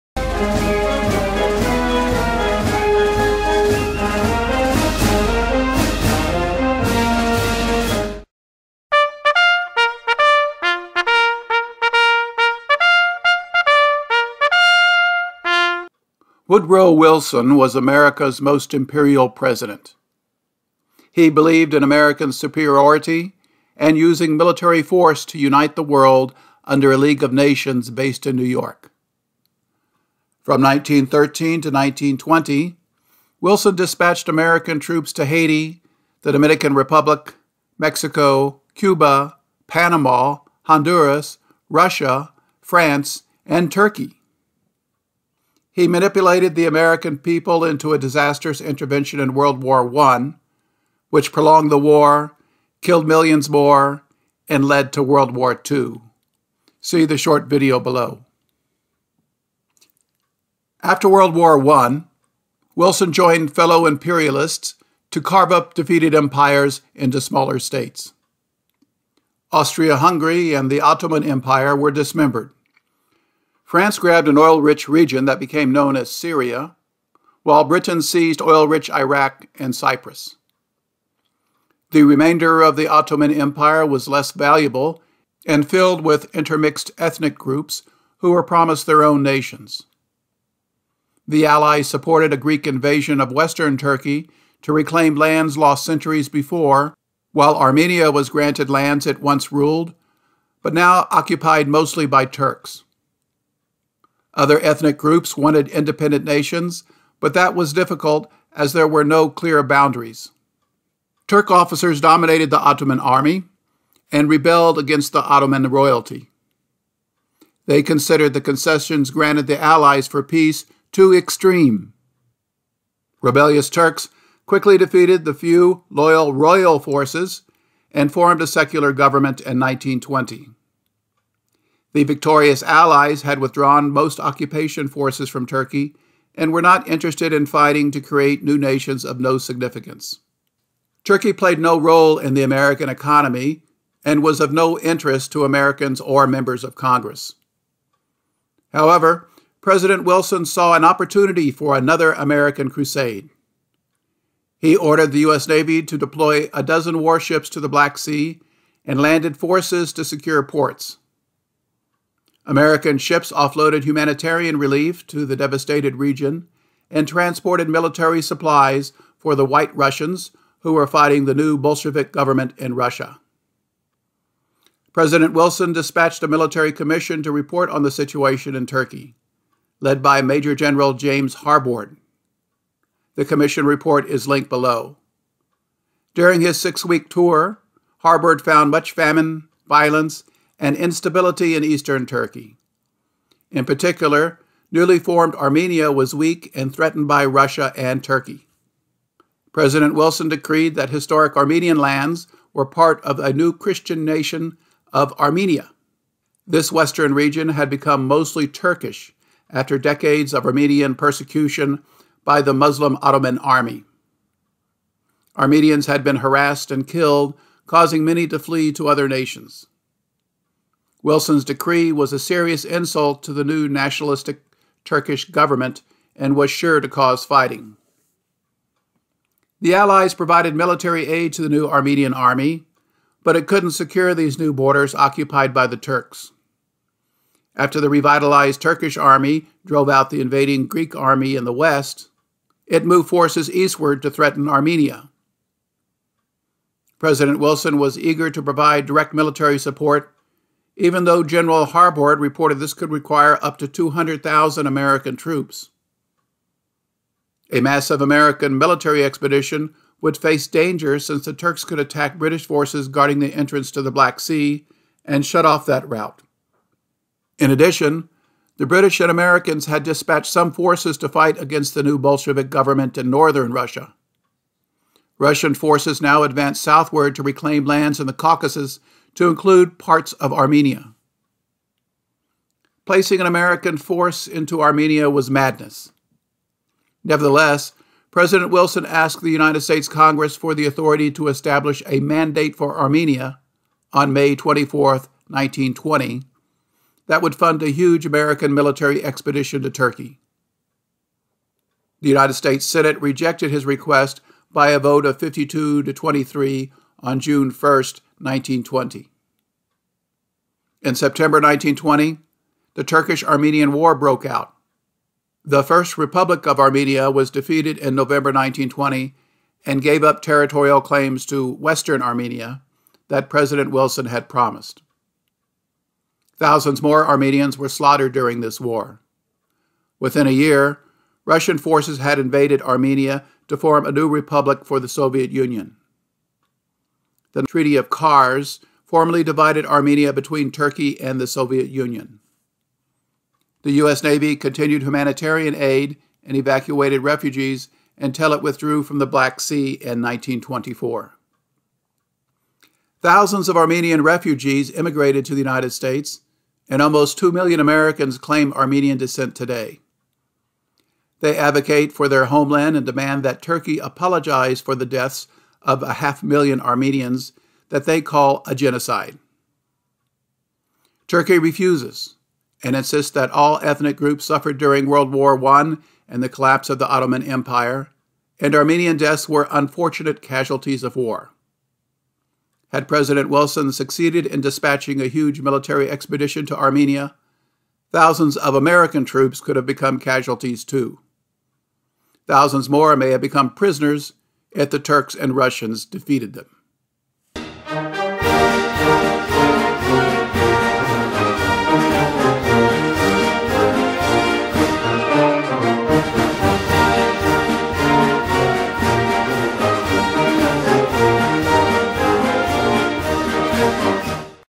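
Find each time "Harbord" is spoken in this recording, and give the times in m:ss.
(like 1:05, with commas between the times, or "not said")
3:01, 3:07, 4:11.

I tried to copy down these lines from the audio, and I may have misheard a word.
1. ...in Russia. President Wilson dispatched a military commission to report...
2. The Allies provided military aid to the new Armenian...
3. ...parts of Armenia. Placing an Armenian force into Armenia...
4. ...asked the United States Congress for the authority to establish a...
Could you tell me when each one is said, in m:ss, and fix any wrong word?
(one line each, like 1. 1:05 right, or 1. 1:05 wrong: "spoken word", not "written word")
1. 2:52 right
2. 3:49 right
3. 4:39 wrong: "American", not "Armenian"
4. 4:48 right.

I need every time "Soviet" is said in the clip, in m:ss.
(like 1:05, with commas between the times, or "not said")
5:34, 5:41.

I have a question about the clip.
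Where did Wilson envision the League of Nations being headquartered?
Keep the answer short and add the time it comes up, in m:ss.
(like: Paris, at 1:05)
New York, at 0:28.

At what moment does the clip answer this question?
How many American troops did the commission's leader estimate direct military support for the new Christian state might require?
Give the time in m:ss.
4:13.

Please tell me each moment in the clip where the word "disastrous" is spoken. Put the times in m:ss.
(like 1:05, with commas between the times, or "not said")
0:47.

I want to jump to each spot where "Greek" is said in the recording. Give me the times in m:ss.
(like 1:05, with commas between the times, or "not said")
1:32, 4:00.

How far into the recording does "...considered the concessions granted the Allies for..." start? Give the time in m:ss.
1:57.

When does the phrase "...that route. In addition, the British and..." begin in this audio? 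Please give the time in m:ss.
4:25.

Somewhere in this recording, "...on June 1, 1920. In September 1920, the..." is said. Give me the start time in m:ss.
5:07.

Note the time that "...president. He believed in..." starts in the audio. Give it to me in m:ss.
0:19.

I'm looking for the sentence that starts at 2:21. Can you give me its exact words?
Turkey played no role in the American economy and was of no interest to Americans or members of Congress.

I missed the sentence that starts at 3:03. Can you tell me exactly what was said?
The commission report is linked below.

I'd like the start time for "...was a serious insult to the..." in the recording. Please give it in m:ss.
3:41.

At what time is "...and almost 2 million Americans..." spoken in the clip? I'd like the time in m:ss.
5:56.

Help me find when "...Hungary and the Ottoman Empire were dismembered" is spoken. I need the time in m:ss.
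1:09.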